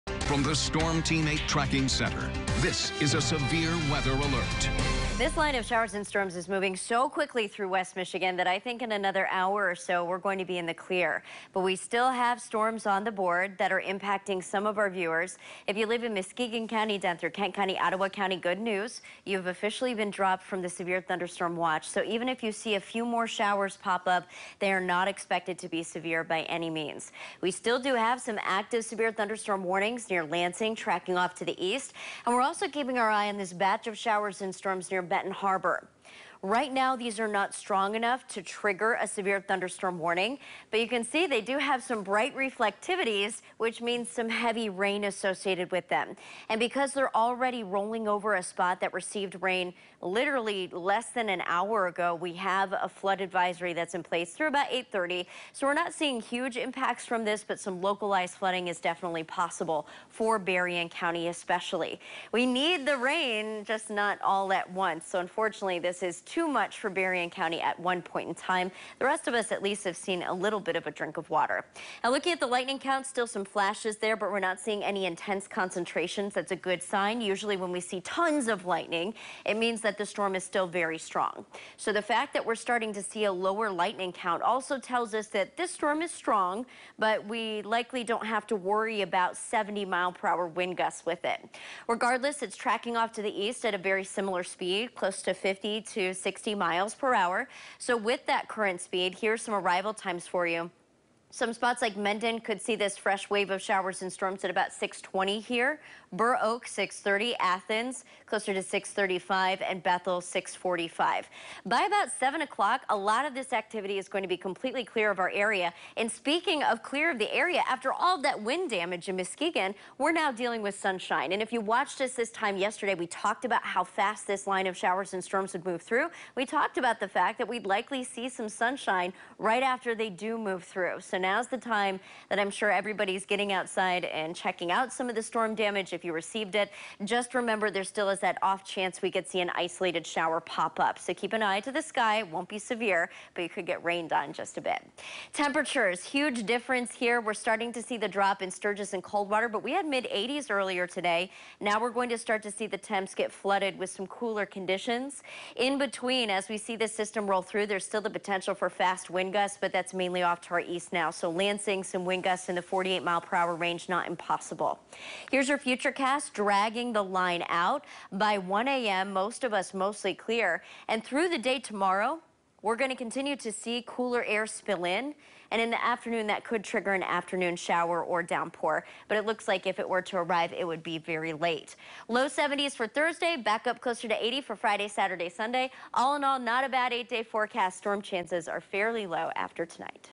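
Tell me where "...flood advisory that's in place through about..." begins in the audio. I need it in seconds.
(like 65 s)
52 s.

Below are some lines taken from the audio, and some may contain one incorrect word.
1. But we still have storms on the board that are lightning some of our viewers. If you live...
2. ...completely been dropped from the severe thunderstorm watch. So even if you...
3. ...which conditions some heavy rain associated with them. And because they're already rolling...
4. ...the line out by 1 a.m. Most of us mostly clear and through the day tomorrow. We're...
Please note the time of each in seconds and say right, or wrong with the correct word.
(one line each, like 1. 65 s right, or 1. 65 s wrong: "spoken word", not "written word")
1. 11 s wrong: "impacting", not "lightning"
2. 19 s wrong: "officially", not "completely"
3. 43 s wrong: "means", not "conditions"
4. 166 s right.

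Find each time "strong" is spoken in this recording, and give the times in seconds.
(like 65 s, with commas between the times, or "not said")
37 s, 80 s, 86 s.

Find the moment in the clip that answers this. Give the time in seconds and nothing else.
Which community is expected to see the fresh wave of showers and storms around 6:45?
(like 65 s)
109 s.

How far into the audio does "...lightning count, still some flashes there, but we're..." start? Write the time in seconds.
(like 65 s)
72 s.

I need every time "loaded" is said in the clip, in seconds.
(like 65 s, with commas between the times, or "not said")
not said.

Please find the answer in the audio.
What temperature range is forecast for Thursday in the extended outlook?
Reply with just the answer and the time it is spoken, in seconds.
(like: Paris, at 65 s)
Low 70s, at 182 s.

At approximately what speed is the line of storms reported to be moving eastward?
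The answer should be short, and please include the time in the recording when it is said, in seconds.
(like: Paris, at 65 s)
50 to 60 mph, at 95 s.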